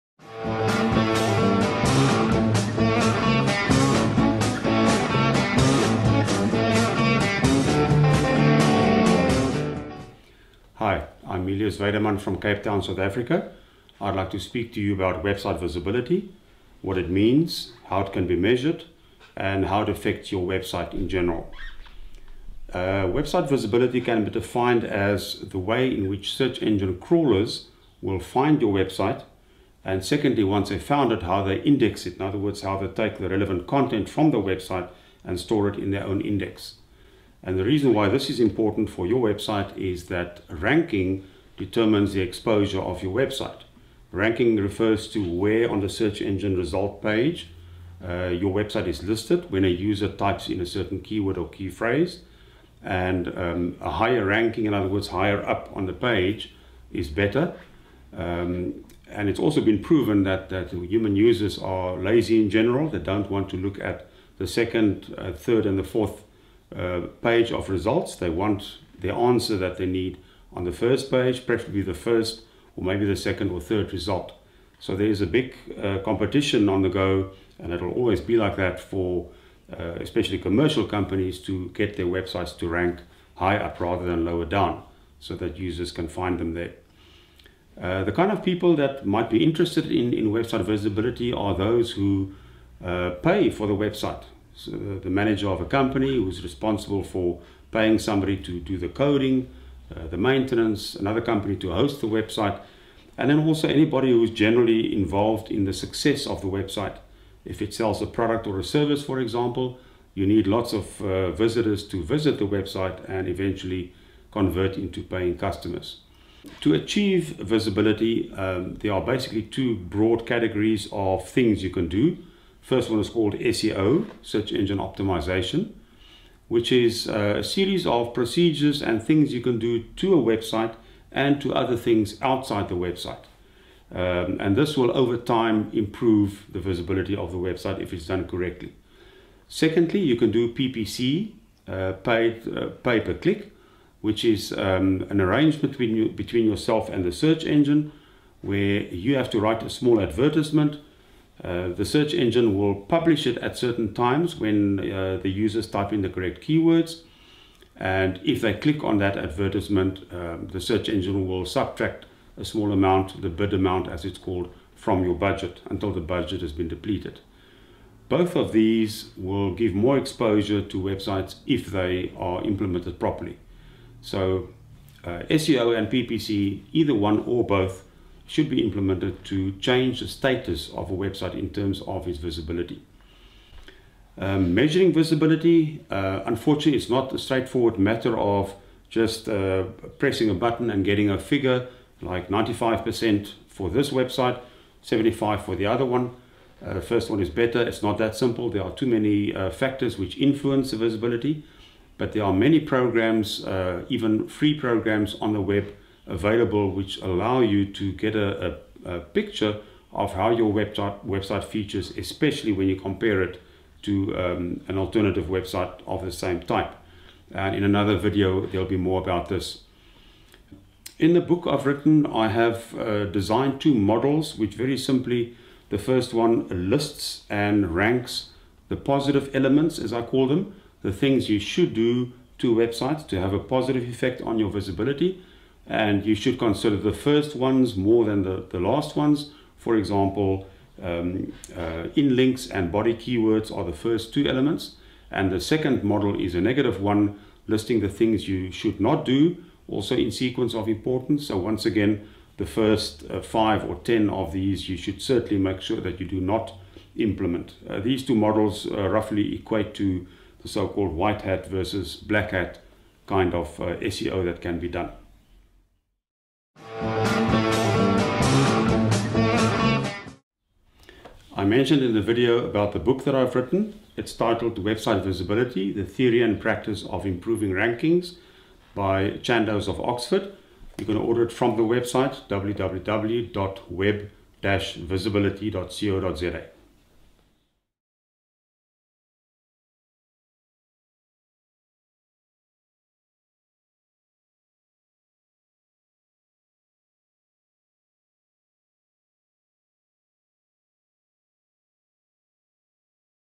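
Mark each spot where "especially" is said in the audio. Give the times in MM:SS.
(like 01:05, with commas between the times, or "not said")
01:19, 03:31.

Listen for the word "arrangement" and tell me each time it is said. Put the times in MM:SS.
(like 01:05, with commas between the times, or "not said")
02:25.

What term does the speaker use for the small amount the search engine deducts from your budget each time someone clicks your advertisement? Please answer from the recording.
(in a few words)
bid amount.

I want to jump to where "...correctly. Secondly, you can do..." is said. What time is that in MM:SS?
02:18.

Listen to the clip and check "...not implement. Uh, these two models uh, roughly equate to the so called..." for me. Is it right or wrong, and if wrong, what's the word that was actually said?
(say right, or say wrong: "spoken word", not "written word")
right.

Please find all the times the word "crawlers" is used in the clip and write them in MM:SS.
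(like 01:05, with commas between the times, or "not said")
00:26.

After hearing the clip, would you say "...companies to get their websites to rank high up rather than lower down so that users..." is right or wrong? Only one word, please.
right.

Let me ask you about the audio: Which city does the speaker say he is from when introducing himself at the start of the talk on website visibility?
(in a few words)
Cape Town.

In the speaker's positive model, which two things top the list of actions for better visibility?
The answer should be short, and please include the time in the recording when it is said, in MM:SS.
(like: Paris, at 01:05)
in links and body keywords, at 04:01.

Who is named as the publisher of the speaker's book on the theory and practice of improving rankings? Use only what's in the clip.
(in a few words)
Chandos of Oxford.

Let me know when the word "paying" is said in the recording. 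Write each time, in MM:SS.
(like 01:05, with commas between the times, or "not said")
01:37, 01:55.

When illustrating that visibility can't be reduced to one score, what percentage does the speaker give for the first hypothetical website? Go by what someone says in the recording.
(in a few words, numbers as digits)
95%.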